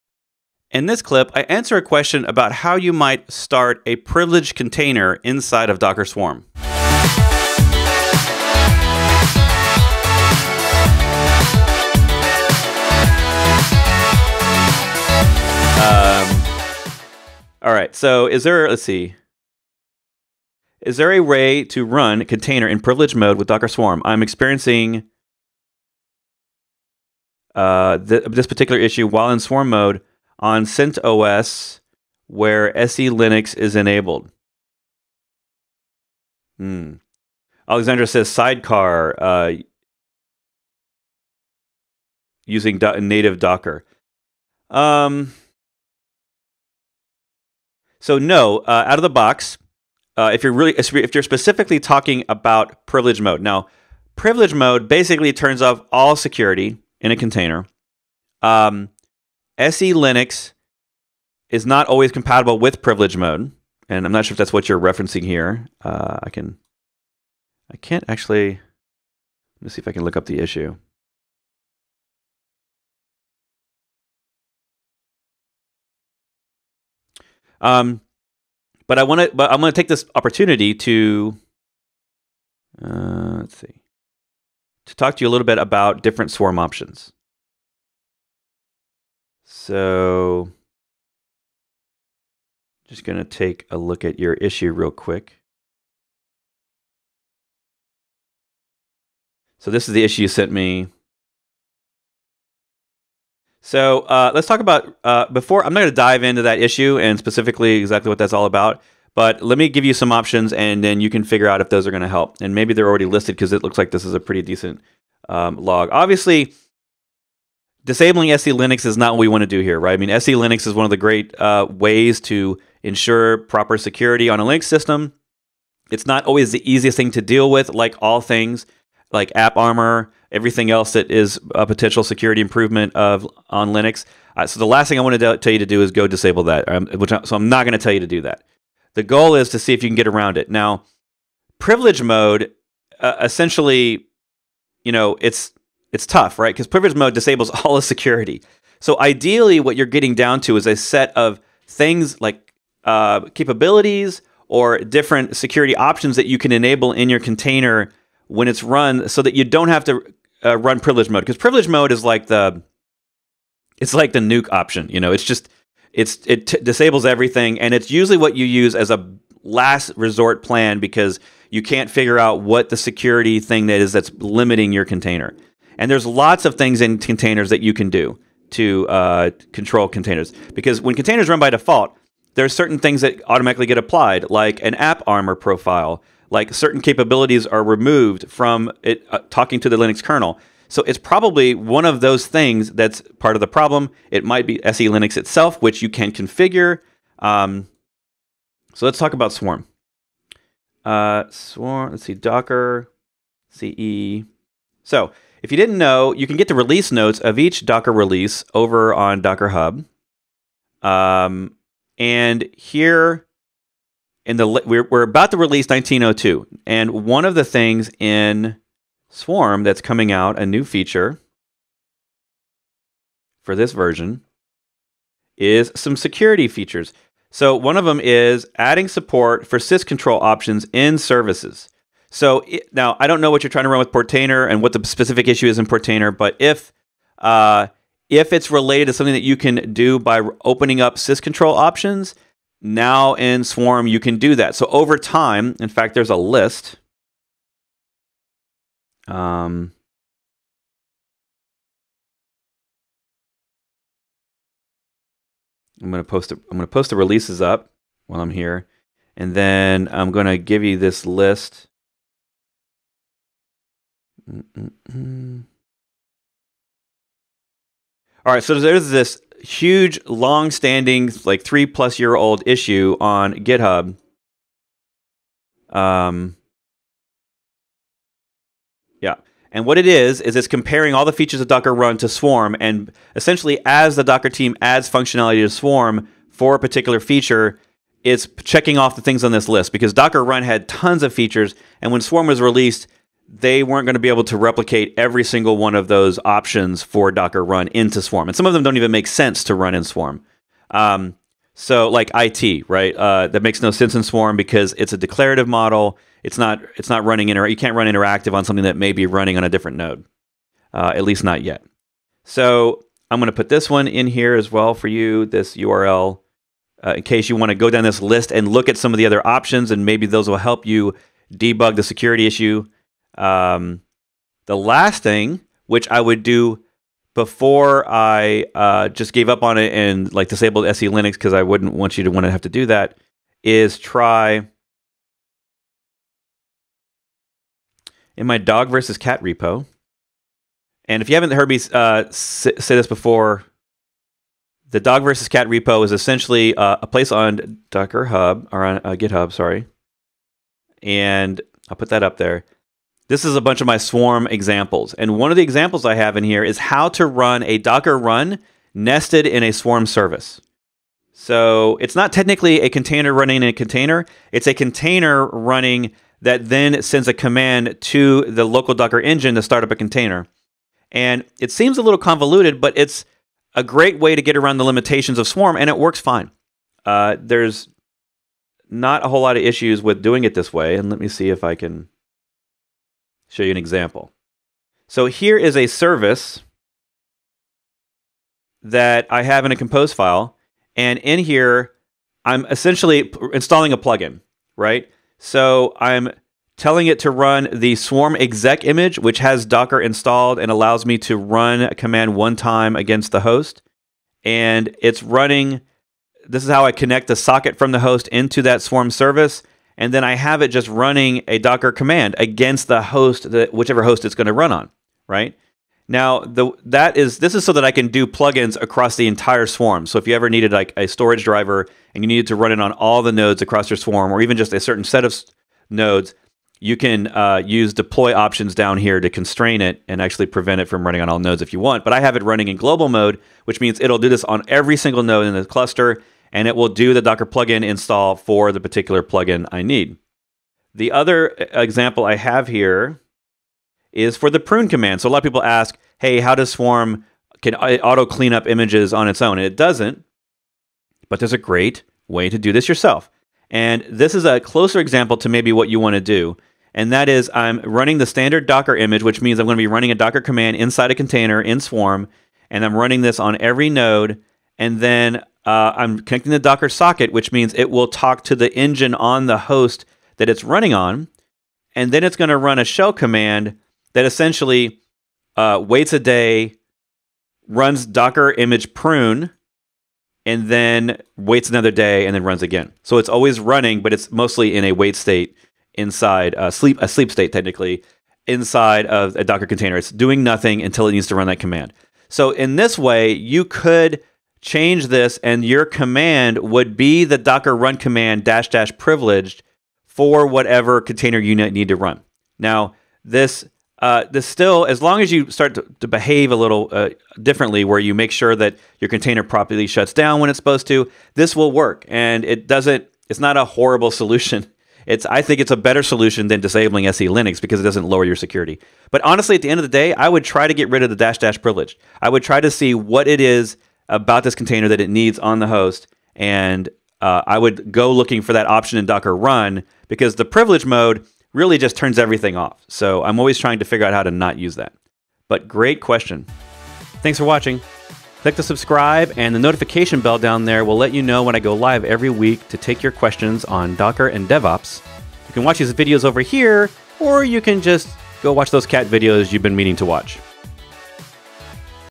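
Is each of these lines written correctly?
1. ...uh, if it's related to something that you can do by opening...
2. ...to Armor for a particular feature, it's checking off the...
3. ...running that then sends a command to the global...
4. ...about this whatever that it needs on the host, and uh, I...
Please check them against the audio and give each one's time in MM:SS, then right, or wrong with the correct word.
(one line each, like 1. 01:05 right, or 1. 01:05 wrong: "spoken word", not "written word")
1. 03:57 right
2. 04:45 wrong: "Swarm", not "Armor"
3. 06:05 wrong: "local", not "global"
4. 08:43 wrong: "container", not "whatever".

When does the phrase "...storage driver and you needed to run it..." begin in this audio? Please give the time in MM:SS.
07:00.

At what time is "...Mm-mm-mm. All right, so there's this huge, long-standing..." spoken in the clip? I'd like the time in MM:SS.
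04:24.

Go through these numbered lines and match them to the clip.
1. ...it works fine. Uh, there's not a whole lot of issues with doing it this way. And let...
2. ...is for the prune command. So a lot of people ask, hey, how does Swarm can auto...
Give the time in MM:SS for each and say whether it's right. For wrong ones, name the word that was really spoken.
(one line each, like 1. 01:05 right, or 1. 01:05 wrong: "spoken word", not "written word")
1. 06:15 right
2. 07:23 right.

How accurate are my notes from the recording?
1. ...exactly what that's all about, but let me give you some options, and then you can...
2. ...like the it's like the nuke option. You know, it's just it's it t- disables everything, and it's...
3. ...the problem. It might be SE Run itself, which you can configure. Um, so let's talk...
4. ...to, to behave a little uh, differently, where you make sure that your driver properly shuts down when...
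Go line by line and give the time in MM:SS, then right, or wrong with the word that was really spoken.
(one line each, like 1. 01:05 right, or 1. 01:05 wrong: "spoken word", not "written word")
1. 01:47 right
2. 02:42 right
3. 03:13 wrong: "Linux", not "Run"
4. 08:25 wrong: "container", not "driver".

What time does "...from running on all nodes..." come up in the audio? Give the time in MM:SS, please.
07:10.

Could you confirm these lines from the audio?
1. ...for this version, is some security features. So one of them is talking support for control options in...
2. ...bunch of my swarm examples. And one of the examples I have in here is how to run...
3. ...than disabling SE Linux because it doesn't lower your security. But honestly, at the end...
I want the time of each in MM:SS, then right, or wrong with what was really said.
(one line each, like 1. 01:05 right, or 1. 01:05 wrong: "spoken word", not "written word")
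1. 03:43 wrong: "adding", not "talking"
2. 05:53 right
3. 08:36 right.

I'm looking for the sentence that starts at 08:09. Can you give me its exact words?
It's doing nothing until it needs to run that command.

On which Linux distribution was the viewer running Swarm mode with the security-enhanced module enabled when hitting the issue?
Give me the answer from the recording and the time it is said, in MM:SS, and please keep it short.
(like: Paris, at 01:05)
CentOS, at 00:30.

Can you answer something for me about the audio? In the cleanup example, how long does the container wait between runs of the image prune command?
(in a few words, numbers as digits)
a day.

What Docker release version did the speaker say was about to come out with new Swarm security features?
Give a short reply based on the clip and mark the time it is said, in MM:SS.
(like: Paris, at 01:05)
1902, at 03:35.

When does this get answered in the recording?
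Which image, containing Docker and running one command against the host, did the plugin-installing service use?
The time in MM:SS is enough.
06:37.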